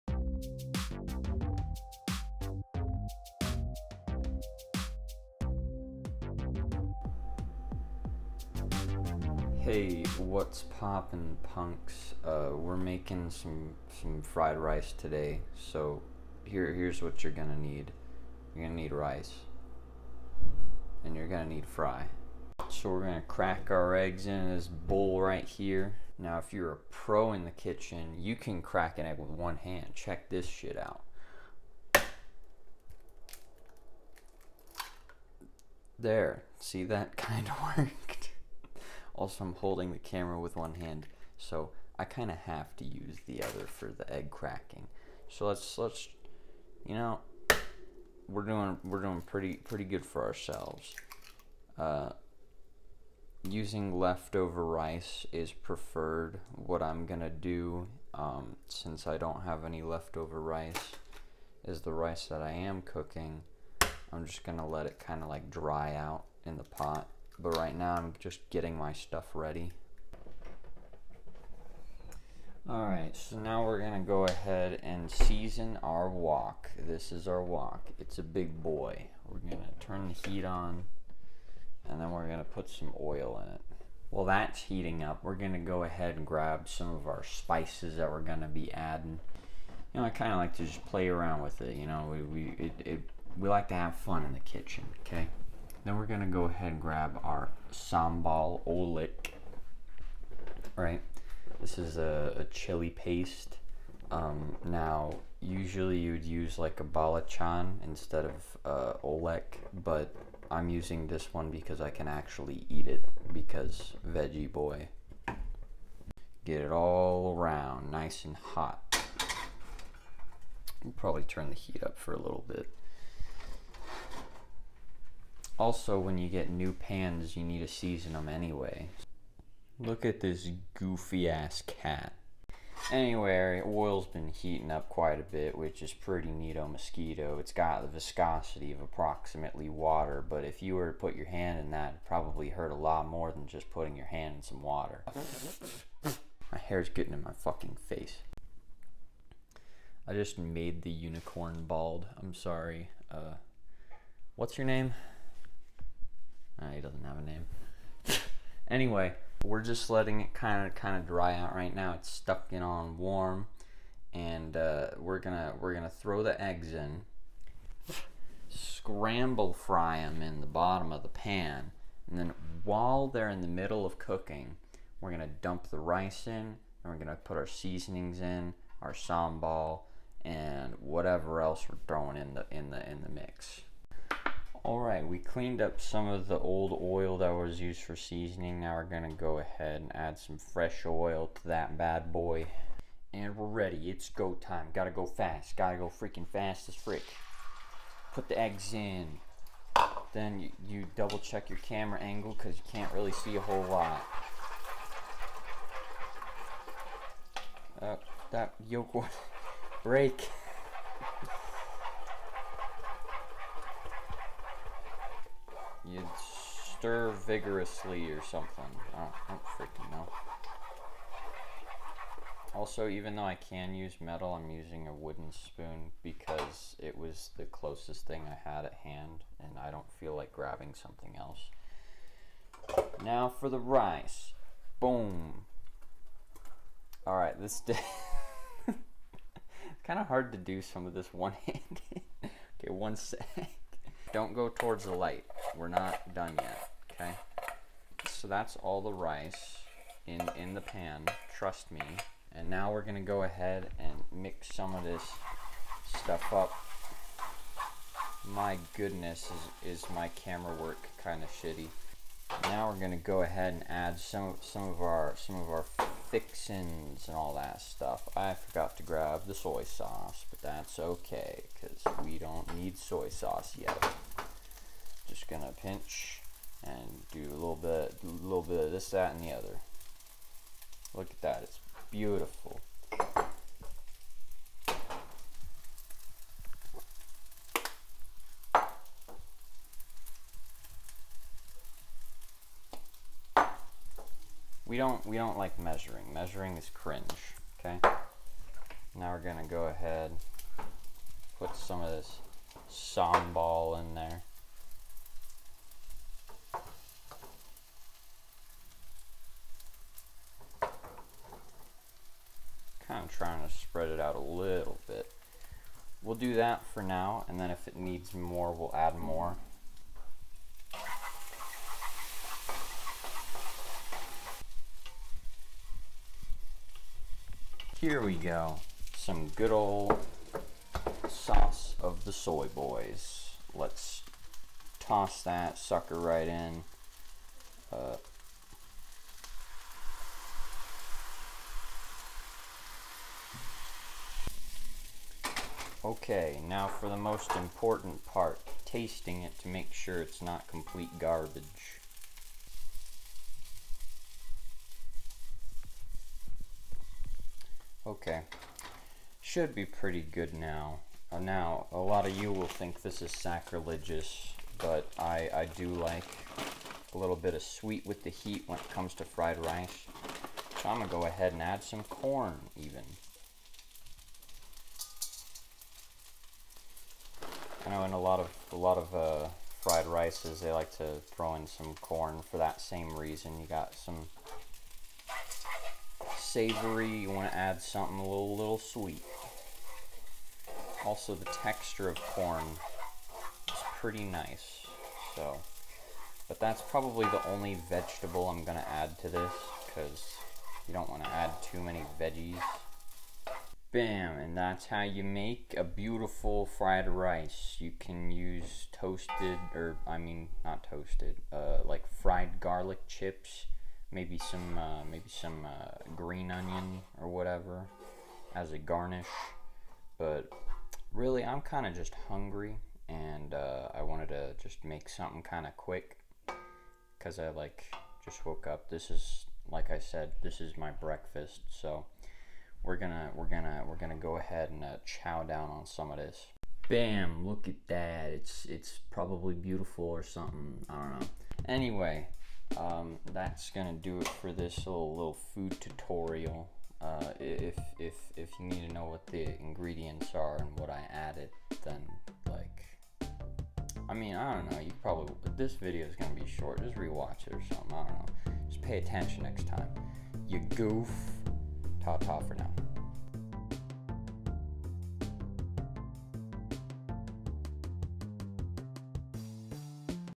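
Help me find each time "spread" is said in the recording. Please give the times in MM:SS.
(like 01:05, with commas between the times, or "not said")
05:13.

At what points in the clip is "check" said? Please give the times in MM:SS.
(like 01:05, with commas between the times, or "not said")
00:29, 03:21.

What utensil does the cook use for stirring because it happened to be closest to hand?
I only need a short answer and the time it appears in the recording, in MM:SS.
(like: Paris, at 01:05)
wooden spoon, at 03:44.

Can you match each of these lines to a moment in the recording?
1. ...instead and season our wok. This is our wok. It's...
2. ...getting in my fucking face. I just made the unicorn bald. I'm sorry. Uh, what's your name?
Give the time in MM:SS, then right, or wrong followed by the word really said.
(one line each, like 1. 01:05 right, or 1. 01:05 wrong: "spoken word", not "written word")
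1. 01:14 wrong: "ahead", not "instead"
2. 02:26 right.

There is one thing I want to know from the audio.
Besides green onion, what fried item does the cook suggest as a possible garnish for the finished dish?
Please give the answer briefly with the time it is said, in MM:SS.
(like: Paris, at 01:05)
fried garlic chips, at 06:51.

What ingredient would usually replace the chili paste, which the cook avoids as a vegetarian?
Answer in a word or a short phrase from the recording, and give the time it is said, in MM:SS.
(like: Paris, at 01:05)
balachan, at 01:46.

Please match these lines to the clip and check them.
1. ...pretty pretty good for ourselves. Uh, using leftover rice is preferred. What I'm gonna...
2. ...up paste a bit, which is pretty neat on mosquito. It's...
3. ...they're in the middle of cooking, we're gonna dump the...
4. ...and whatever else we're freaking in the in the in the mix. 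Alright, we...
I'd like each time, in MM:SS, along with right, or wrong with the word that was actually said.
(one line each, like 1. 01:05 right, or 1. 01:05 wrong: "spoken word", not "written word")
1. 00:49 right
2. 02:14 wrong: "quite", not "paste"
3. 02:53 right
4. 03:00 wrong: "throwing", not "freaking".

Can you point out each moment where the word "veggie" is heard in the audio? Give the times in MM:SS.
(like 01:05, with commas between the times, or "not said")
01:54, 06:41.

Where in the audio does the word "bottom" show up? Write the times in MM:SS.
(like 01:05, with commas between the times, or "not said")
02:50.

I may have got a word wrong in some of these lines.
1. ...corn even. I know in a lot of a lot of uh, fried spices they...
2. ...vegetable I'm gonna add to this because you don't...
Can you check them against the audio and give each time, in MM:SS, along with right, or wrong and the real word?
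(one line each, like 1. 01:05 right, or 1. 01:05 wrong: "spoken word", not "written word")
1. 06:11 wrong: "rices", not "spices"
2. 06:37 right.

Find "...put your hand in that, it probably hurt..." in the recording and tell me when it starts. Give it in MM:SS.
02:20.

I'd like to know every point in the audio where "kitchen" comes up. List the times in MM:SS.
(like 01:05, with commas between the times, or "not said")
00:27, 01:34.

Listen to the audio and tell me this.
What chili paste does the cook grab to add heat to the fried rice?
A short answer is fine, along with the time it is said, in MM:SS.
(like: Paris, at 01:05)
sambal oelek, at 01:37.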